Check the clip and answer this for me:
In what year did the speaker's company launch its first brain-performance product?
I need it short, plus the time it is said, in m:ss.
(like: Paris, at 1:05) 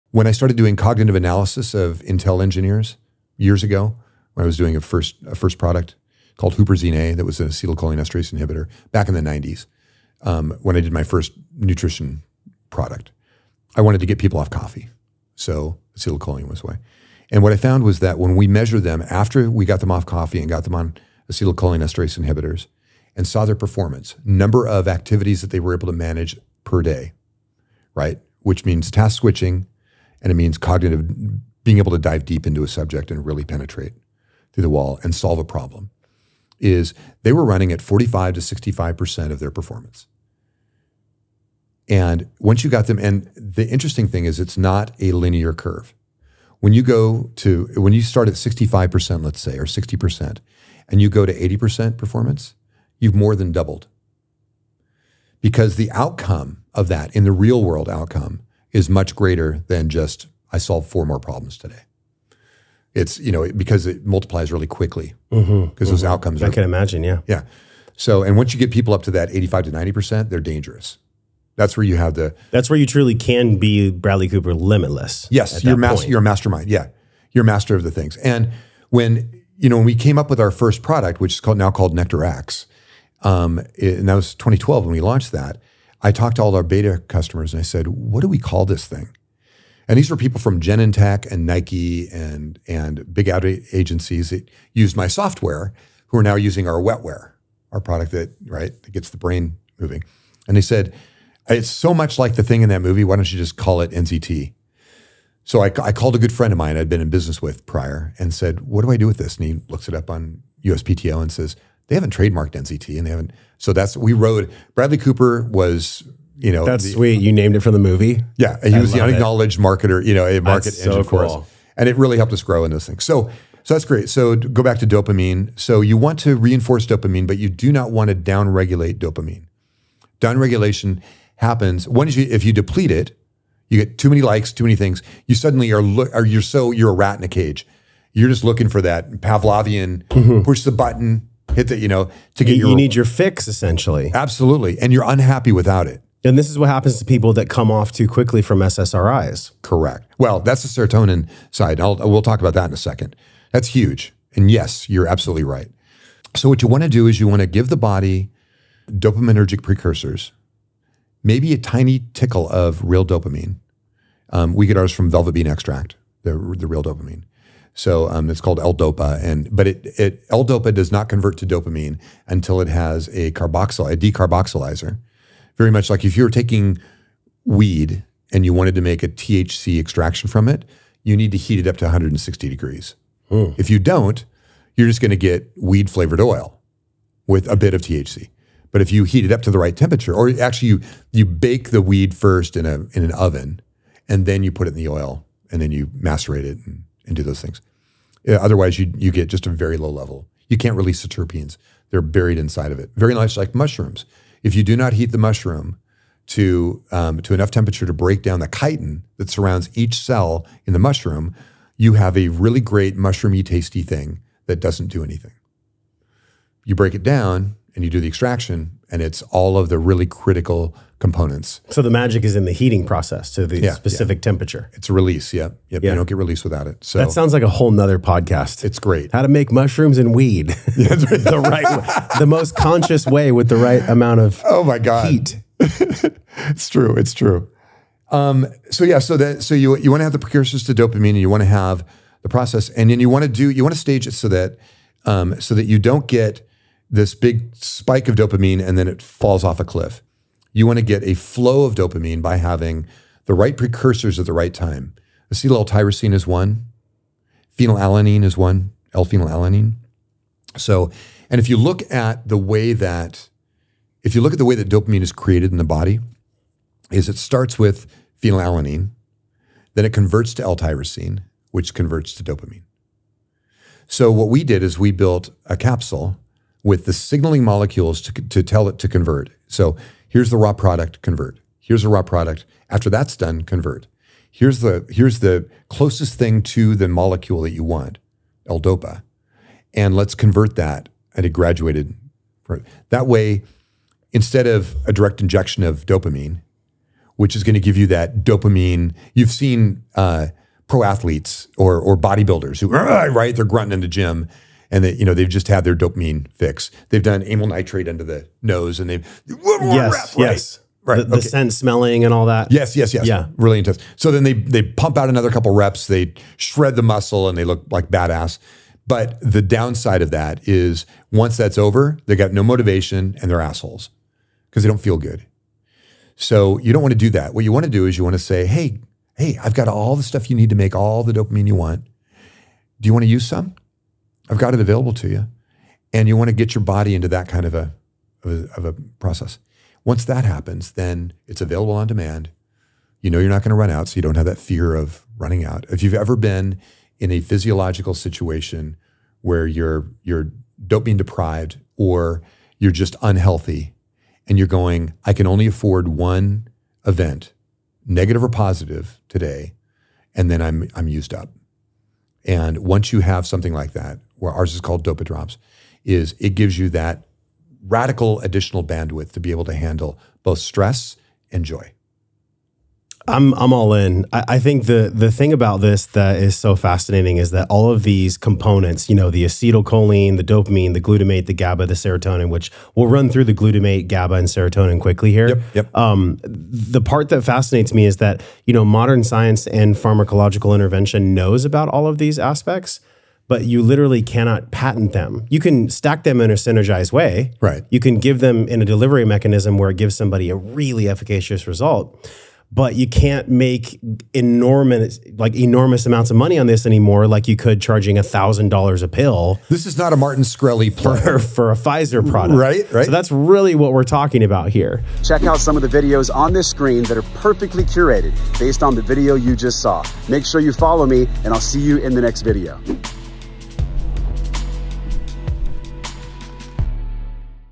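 2012, at 1:24.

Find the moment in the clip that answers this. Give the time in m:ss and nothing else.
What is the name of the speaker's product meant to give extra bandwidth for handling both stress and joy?
6:04.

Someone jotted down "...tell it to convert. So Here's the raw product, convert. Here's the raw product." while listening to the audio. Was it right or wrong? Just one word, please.
right.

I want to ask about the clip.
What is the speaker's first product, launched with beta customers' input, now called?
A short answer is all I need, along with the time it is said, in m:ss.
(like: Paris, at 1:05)
Nectar X, at 1:21.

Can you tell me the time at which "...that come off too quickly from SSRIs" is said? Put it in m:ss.
2:27.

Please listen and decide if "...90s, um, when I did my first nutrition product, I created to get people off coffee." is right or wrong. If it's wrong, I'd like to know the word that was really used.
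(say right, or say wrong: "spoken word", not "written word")
wrong: "wanted", not "created".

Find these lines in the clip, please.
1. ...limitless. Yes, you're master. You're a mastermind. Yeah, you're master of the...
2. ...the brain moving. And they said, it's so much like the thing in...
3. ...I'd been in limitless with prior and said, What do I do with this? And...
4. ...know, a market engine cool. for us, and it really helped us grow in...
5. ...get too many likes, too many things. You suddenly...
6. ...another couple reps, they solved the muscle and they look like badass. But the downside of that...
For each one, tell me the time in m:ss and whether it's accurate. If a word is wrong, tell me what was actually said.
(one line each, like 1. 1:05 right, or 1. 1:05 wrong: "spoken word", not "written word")
1. 1:14 right
2. 1:39 right
3. 1:46 wrong: "business", not "limitless"
4. 2:00 right
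5. 2:13 right
6. 5:15 wrong: "shred", not "solved".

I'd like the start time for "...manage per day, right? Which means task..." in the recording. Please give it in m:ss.
0:25.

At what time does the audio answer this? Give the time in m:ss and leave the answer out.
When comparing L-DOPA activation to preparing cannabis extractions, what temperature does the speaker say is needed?
3:01.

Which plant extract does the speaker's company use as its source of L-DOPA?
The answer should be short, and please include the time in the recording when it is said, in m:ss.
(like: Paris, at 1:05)
Velvet bean extract, at 2:45.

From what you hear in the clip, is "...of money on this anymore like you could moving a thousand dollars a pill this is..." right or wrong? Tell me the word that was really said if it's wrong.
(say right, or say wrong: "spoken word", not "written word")
wrong: "charging", not "moving".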